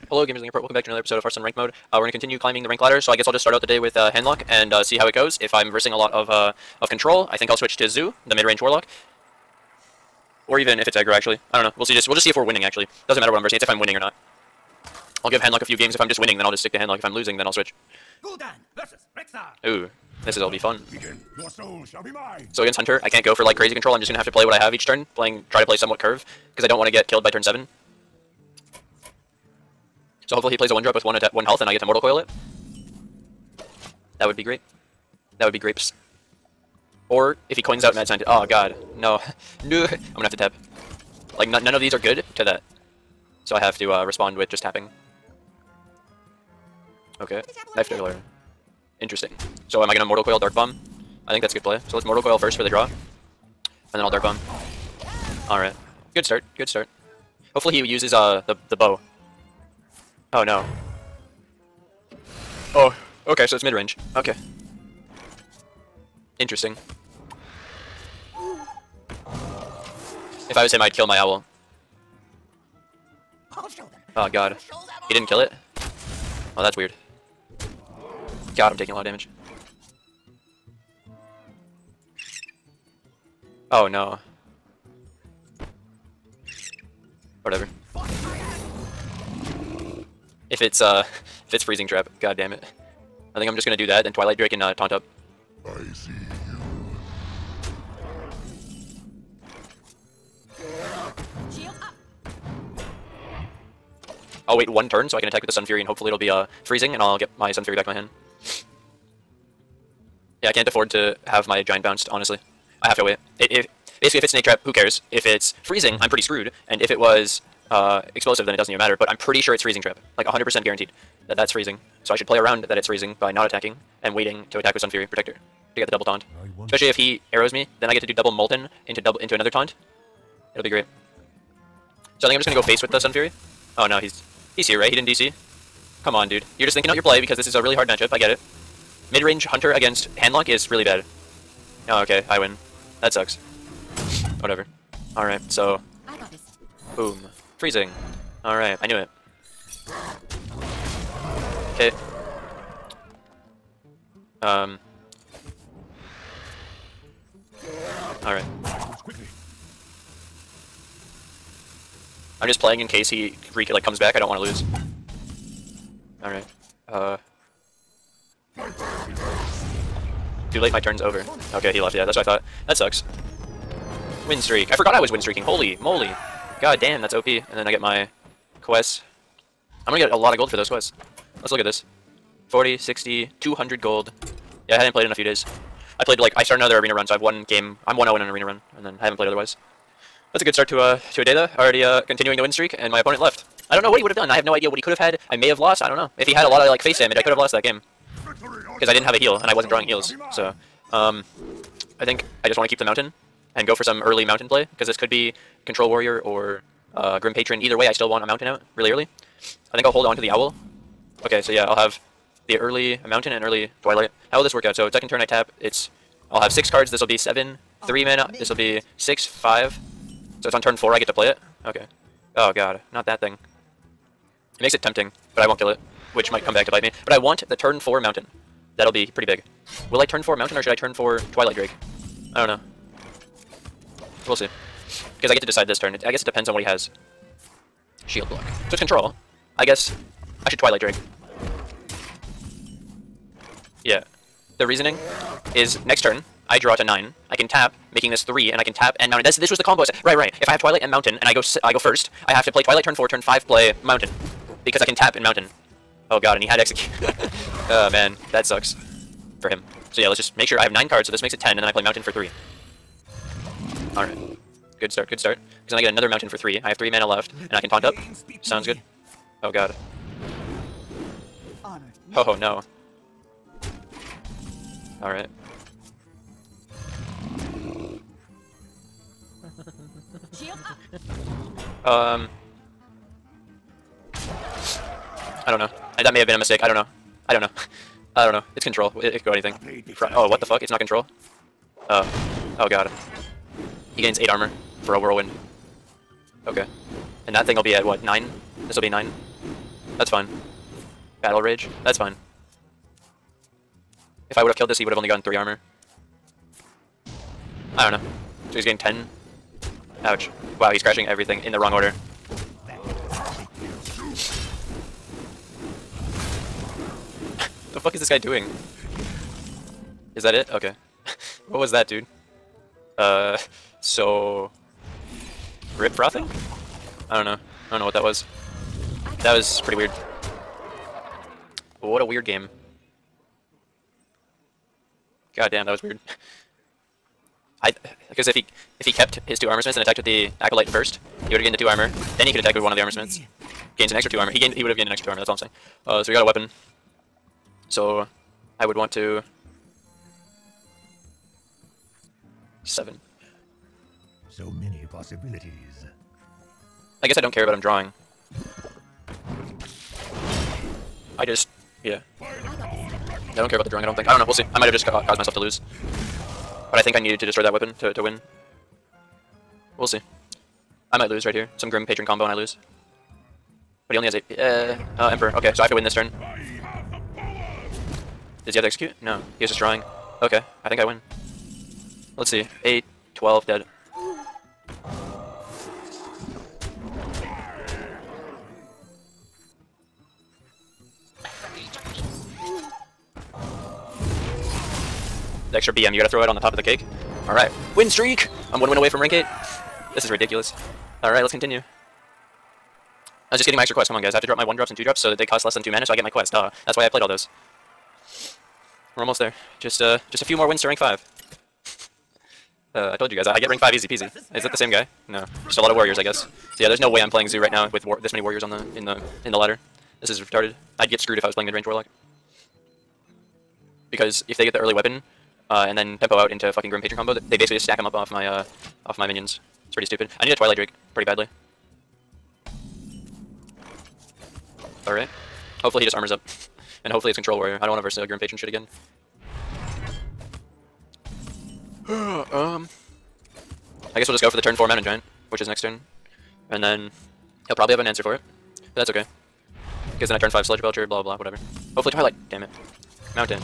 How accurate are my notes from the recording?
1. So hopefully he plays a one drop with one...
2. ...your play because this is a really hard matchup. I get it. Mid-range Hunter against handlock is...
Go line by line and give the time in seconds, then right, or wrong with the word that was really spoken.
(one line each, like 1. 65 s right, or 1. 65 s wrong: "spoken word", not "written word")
1. 30 s right
2. 136 s right.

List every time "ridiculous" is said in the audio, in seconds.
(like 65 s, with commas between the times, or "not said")
400 s.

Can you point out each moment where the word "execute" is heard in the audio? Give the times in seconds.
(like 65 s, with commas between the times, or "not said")
256 s, 378 s.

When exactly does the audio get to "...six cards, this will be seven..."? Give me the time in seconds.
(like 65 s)
216 s.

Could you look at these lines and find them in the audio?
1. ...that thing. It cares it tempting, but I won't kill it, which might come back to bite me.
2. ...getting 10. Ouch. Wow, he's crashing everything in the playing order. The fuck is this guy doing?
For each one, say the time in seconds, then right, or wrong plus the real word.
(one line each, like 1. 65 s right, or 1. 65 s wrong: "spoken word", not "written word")
1. 223 s wrong: "makes", not "cares"
2. 308 s wrong: "wrong", not "playing".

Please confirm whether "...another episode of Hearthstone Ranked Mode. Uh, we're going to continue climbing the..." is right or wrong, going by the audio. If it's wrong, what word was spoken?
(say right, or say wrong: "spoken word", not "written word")
right.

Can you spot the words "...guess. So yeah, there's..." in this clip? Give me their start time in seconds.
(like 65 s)
416 s.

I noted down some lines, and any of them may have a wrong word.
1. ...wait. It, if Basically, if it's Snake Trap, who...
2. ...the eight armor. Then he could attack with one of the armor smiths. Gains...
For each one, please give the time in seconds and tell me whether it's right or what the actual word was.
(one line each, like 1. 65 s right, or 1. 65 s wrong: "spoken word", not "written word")
1. 113 s right
2. 341 s wrong: "two", not "eight".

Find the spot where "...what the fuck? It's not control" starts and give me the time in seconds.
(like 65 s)
290 s.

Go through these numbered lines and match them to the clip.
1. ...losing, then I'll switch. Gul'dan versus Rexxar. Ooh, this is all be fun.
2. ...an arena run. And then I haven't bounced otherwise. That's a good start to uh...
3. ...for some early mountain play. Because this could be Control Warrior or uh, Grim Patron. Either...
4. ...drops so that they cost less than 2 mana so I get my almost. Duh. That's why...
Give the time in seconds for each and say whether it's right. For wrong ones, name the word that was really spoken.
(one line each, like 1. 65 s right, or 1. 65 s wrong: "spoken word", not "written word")
1. 17 s right
2. 188 s wrong: "played", not "bounced"
3. 203 s right
4. 404 s wrong: "quest", not "almost".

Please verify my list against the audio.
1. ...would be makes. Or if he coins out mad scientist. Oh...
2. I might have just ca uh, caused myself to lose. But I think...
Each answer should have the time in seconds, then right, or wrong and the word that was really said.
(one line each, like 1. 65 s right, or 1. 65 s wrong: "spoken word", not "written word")
1. 35 s wrong: "grapes", not "makes"
2. 364 s right.